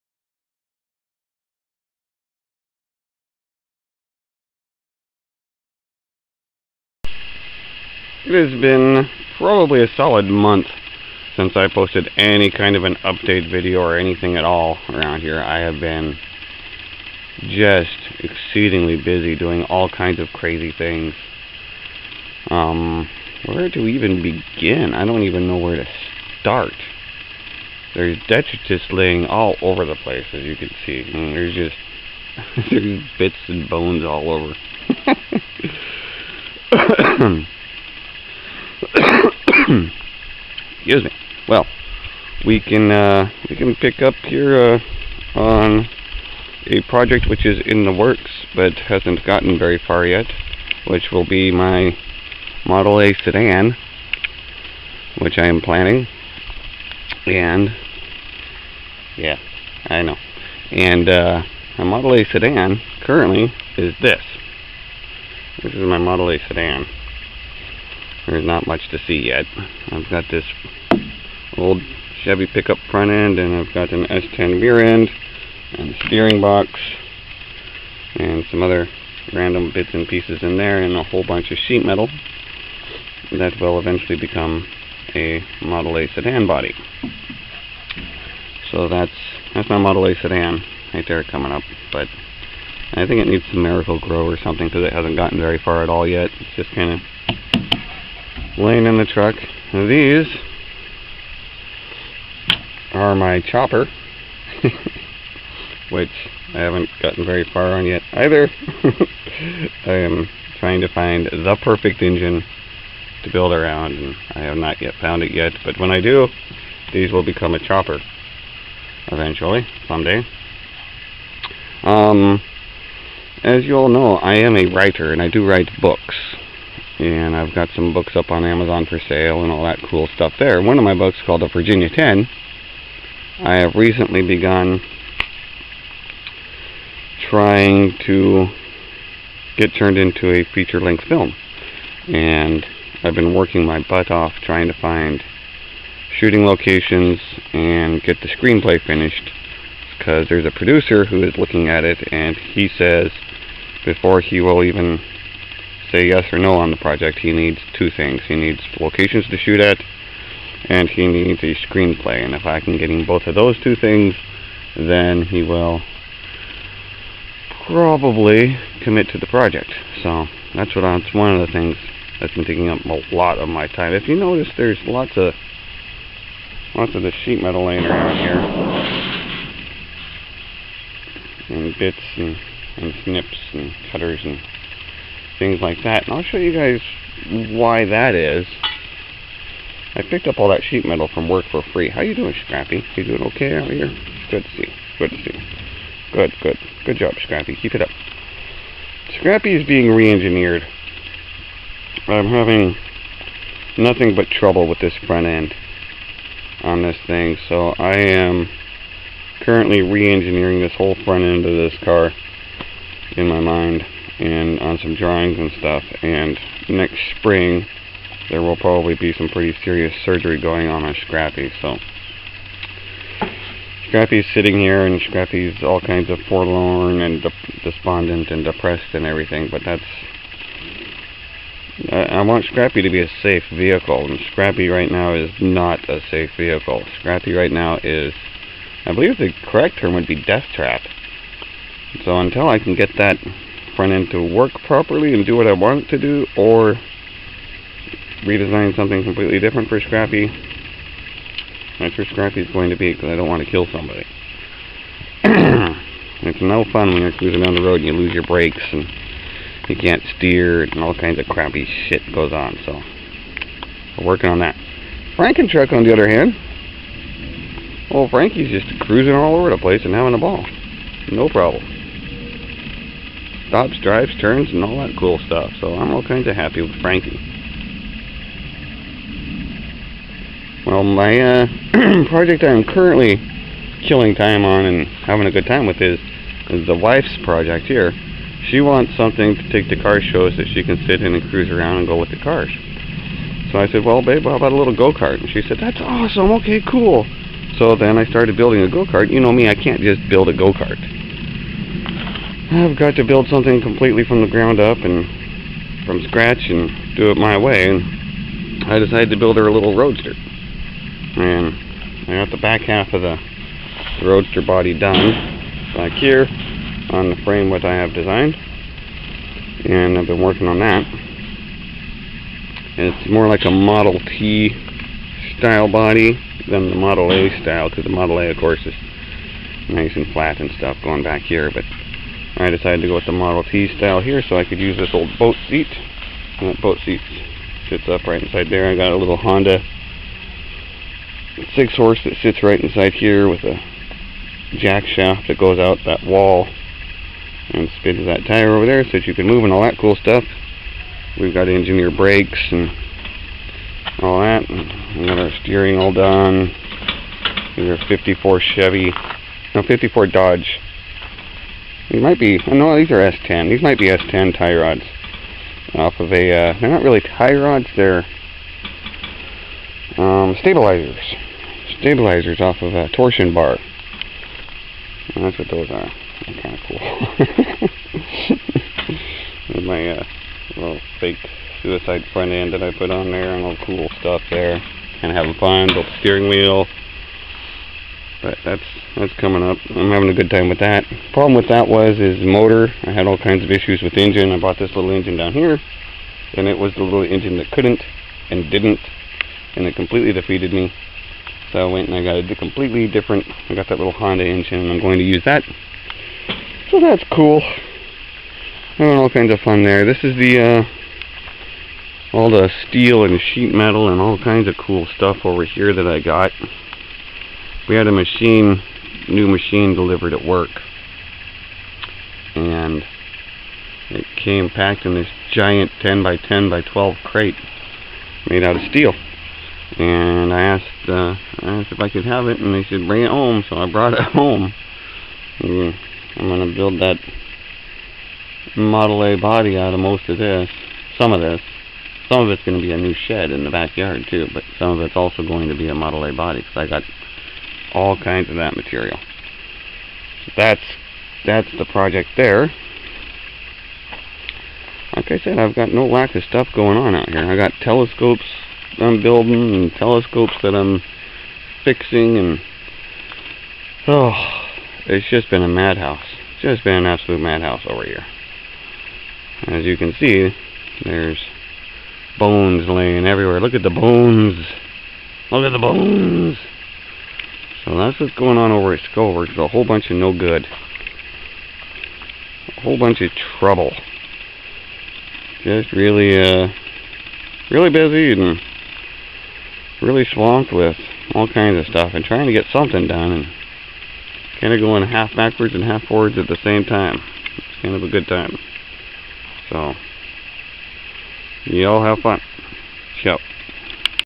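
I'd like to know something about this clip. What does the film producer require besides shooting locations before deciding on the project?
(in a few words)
A screenplay.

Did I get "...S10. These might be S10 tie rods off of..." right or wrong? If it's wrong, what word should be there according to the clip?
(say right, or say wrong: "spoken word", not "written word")
right.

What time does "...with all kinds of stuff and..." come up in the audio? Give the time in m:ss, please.
8:10.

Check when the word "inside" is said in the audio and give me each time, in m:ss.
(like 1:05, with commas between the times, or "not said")
5:38, 5:42.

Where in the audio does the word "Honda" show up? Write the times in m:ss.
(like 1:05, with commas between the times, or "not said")
5:39, 6:43.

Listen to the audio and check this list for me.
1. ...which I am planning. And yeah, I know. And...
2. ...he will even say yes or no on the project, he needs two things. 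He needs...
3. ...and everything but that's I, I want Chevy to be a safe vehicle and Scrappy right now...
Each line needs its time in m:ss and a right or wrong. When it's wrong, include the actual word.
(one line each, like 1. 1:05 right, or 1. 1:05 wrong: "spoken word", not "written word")
1. 0:55 right
2. 2:34 right
3. 3:48 wrong: "Scrappy", not "Chevy".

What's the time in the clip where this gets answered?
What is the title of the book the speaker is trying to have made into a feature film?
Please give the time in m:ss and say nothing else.
2:11.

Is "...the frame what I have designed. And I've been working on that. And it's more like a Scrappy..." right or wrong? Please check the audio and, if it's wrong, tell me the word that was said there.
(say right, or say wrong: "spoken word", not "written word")
wrong: "Model", not "Scrappy".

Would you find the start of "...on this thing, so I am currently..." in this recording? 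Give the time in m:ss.
3:26.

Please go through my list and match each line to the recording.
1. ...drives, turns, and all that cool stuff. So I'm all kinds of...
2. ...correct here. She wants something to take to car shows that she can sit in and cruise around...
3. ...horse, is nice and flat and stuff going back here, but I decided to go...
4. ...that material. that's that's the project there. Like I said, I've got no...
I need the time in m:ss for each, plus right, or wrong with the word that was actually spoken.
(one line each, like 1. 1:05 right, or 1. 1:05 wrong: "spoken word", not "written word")
1. 4:33 right
2. 4:47 wrong: "project", not "correct"
3. 5:28 wrong: "course", not "horse"
4. 7:28 right.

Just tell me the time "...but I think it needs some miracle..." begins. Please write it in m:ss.
1:31.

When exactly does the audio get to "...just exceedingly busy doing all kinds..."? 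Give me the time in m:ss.
0:17.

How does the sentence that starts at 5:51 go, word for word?
We've got engineer brakes and all that.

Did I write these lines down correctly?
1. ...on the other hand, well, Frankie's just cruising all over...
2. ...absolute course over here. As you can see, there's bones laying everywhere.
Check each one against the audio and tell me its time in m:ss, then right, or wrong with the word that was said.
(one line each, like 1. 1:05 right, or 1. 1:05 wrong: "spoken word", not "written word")
1. 4:25 right
2. 7:46 wrong: "madhouse", not "course".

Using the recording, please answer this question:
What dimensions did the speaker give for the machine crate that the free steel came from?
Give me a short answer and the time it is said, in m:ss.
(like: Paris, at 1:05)
10 by 10 by 12, at 7:05.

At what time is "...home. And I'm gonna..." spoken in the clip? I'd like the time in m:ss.
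7:14.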